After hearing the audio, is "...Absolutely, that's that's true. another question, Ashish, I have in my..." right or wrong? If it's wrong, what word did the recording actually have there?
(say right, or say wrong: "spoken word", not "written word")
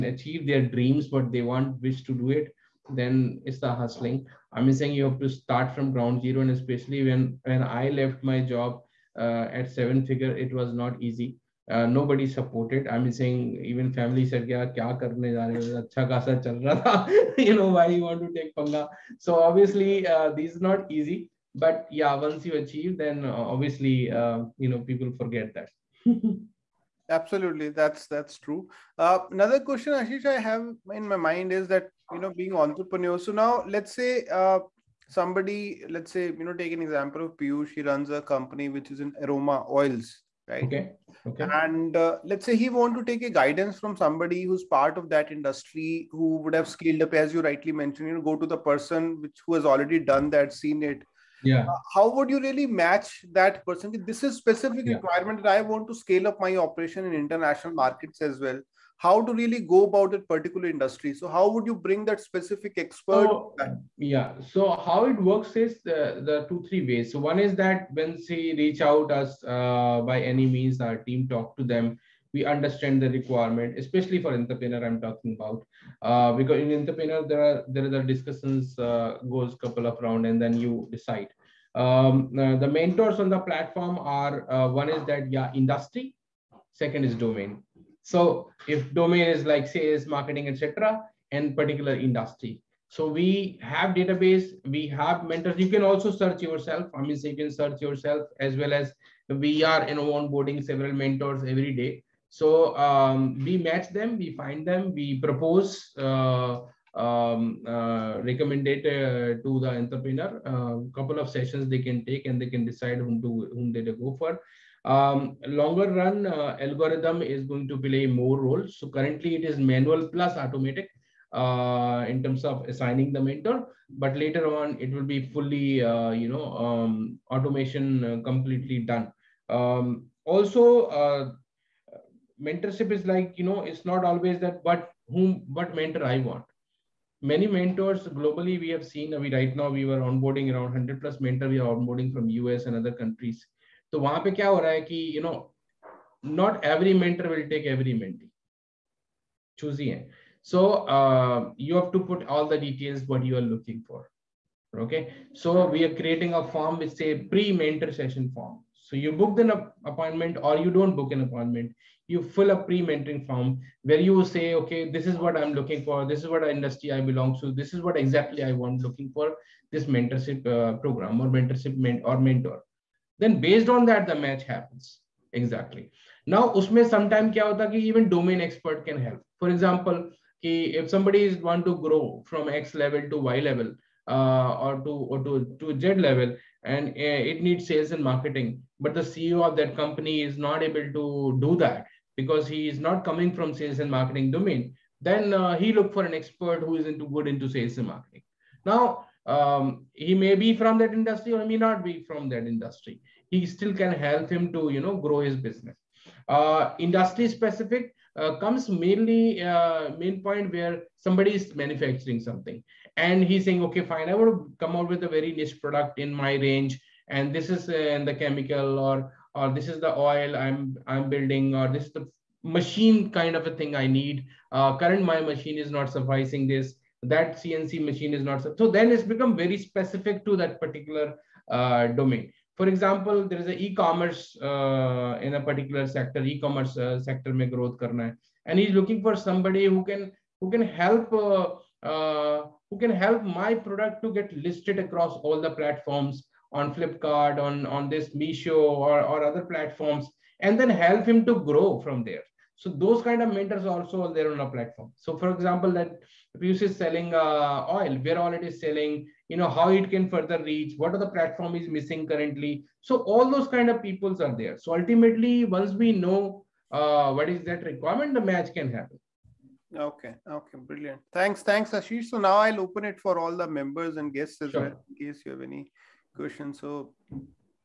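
right.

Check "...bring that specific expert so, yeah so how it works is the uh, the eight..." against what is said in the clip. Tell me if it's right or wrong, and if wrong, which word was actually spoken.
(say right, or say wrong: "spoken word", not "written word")
wrong: "two", not "eight".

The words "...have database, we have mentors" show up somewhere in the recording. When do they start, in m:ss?
1:33.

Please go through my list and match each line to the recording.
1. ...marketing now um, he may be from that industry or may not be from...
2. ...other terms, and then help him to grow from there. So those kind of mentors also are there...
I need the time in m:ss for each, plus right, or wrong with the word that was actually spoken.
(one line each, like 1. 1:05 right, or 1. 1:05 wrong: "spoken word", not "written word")
1. 3:17 right
2. 4:09 wrong: "platforms", not "terms".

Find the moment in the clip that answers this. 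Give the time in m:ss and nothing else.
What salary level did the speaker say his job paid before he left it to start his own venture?
0:09.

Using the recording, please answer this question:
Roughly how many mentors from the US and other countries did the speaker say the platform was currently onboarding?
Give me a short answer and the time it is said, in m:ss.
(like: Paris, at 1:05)
100 plus, at 2:20.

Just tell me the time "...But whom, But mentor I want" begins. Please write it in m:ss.
2:14.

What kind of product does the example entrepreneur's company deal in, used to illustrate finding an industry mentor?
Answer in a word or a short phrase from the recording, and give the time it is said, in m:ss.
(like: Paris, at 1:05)
Aroma oils, at 0:39.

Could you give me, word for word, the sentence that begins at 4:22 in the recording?
So all those kind of peoples are there.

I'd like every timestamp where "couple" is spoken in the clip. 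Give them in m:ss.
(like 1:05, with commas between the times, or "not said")
1:19, 1:50.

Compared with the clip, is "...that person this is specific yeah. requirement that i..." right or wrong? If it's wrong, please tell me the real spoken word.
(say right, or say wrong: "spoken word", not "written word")
right.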